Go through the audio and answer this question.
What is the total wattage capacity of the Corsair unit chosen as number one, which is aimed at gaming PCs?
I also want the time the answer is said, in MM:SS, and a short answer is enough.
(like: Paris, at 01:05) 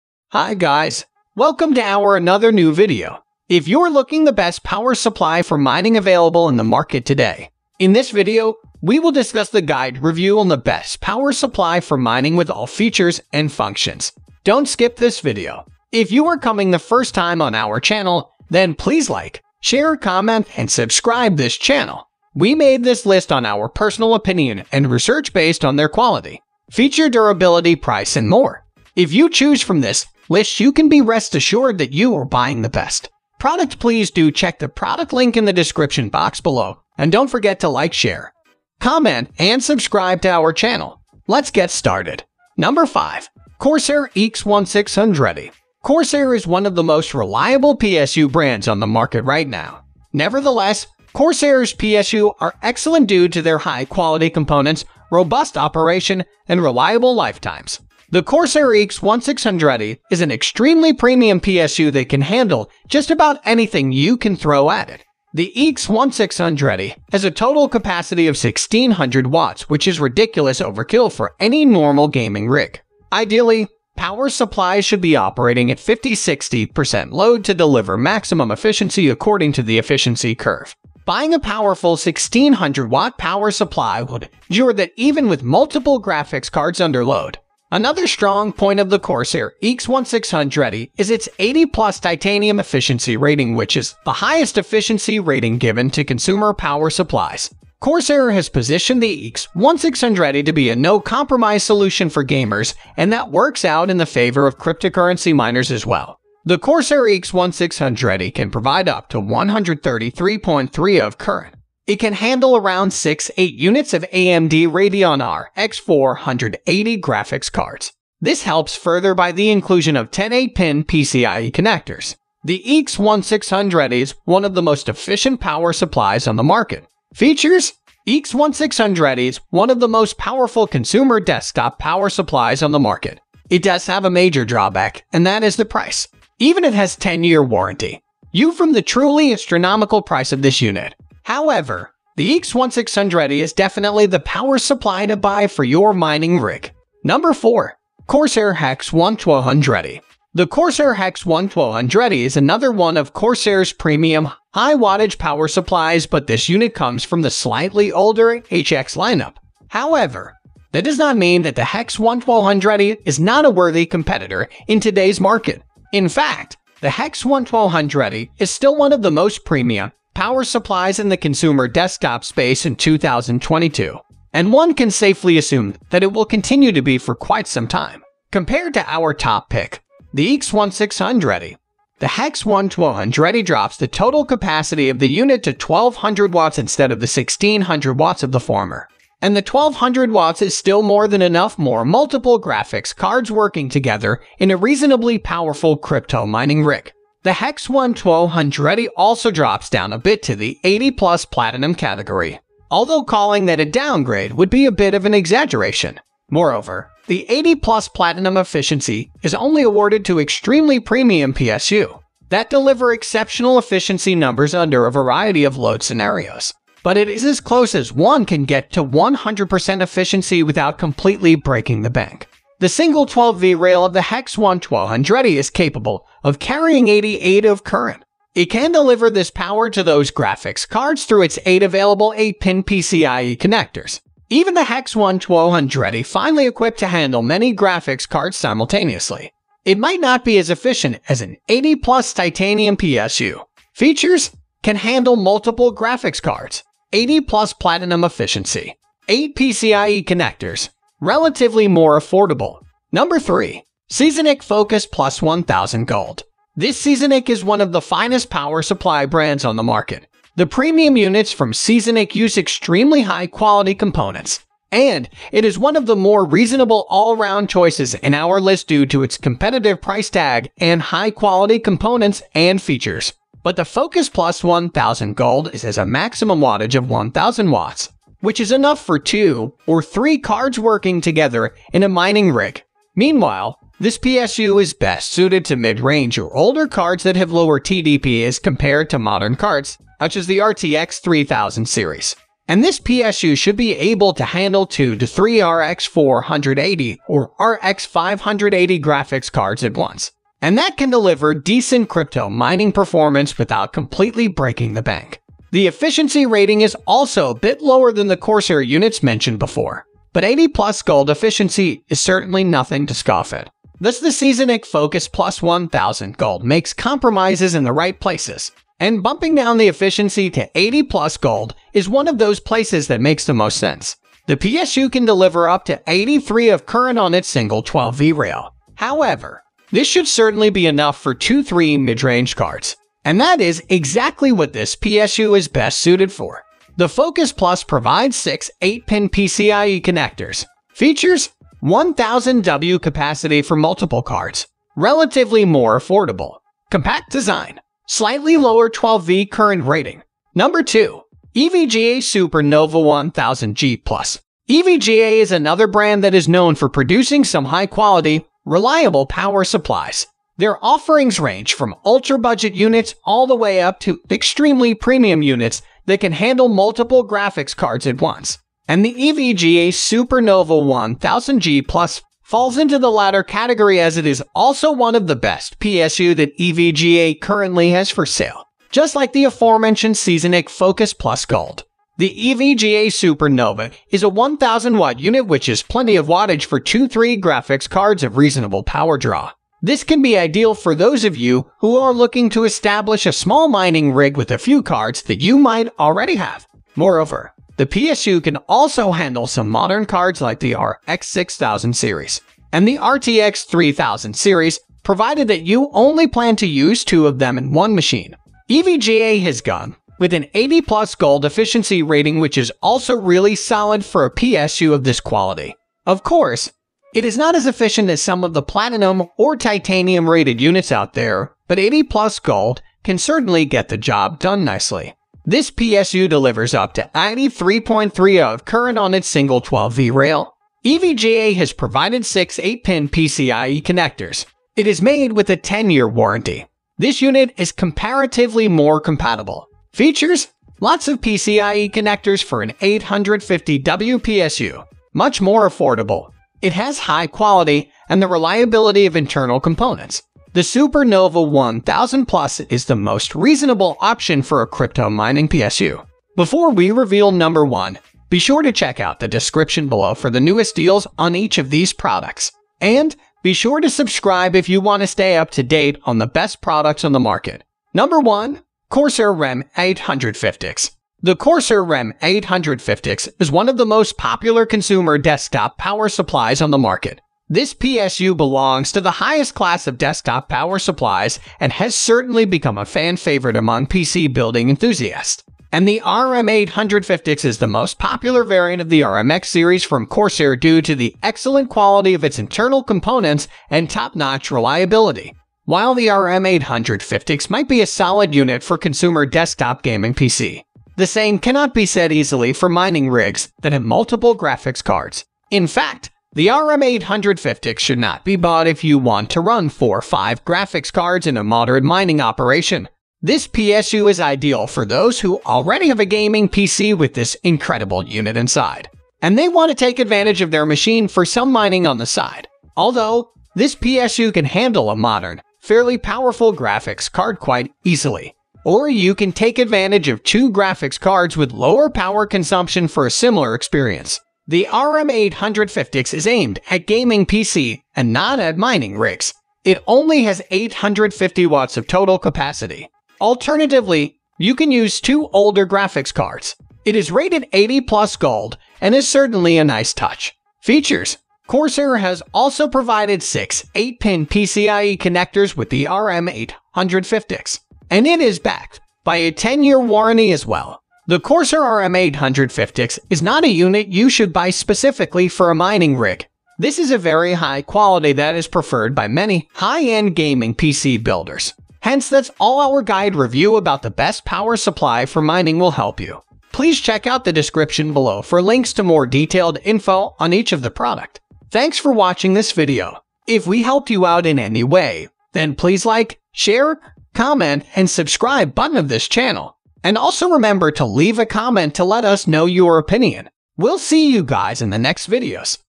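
850 watts, at 09:00.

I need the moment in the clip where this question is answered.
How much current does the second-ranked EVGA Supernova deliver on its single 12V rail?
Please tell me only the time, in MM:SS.
07:06.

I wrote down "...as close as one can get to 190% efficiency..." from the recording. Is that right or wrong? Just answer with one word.
wrong.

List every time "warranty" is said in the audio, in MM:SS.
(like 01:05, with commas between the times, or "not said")
02:17, 07:15, 09:19.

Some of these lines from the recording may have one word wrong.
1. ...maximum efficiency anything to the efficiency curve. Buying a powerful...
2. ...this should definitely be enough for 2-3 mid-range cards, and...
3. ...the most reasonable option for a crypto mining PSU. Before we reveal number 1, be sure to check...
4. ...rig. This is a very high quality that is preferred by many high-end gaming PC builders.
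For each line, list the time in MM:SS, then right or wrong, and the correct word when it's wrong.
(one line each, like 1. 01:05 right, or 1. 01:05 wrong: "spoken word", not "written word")
1. 01:17 wrong: "according", not "anything"
2. 05:29 wrong: "certainly", not "definitely"
3. 07:32 right
4. 09:25 right.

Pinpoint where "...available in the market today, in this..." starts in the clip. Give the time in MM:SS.
00:05.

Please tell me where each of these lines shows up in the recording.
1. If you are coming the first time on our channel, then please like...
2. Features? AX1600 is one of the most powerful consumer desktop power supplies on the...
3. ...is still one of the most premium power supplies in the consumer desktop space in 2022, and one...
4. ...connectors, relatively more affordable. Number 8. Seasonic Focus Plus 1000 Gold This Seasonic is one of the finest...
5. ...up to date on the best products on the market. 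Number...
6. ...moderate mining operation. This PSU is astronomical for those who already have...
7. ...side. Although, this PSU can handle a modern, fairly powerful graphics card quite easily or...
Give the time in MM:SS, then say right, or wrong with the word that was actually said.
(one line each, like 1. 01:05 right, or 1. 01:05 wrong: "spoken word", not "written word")
1. 00:15 right
2. 02:07 right
3. 02:48 right
4. 04:10 wrong: "3", not "8"
5. 07:45 right
6. 08:31 wrong: "ideal", not "astronomical"
7. 08:41 right.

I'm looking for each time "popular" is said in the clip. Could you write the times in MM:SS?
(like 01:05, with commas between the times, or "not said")
07:53, 08:07.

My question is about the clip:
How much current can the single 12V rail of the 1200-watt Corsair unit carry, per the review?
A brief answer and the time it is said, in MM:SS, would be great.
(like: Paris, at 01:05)
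88, at 03:46.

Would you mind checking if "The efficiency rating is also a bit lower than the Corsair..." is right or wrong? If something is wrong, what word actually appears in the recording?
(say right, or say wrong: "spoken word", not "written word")
right.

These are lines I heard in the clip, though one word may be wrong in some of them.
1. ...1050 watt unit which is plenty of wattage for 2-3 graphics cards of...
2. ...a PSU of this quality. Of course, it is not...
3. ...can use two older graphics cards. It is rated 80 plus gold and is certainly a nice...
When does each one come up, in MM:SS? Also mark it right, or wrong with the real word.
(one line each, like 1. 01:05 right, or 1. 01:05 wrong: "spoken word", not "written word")
1. 06:24 wrong: "1000", not "1050"
2. 06:54 right
3. 09:04 right.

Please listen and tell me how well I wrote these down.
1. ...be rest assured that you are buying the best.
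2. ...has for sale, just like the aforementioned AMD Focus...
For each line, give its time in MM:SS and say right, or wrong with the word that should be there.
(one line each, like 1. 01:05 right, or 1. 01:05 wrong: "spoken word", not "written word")
1. 00:30 right
2. 06:17 wrong: "Seasonic", not "AMD".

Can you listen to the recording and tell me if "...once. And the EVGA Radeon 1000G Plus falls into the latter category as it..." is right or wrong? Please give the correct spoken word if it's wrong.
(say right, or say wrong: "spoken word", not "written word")
wrong: "Supernova", not "Radeon".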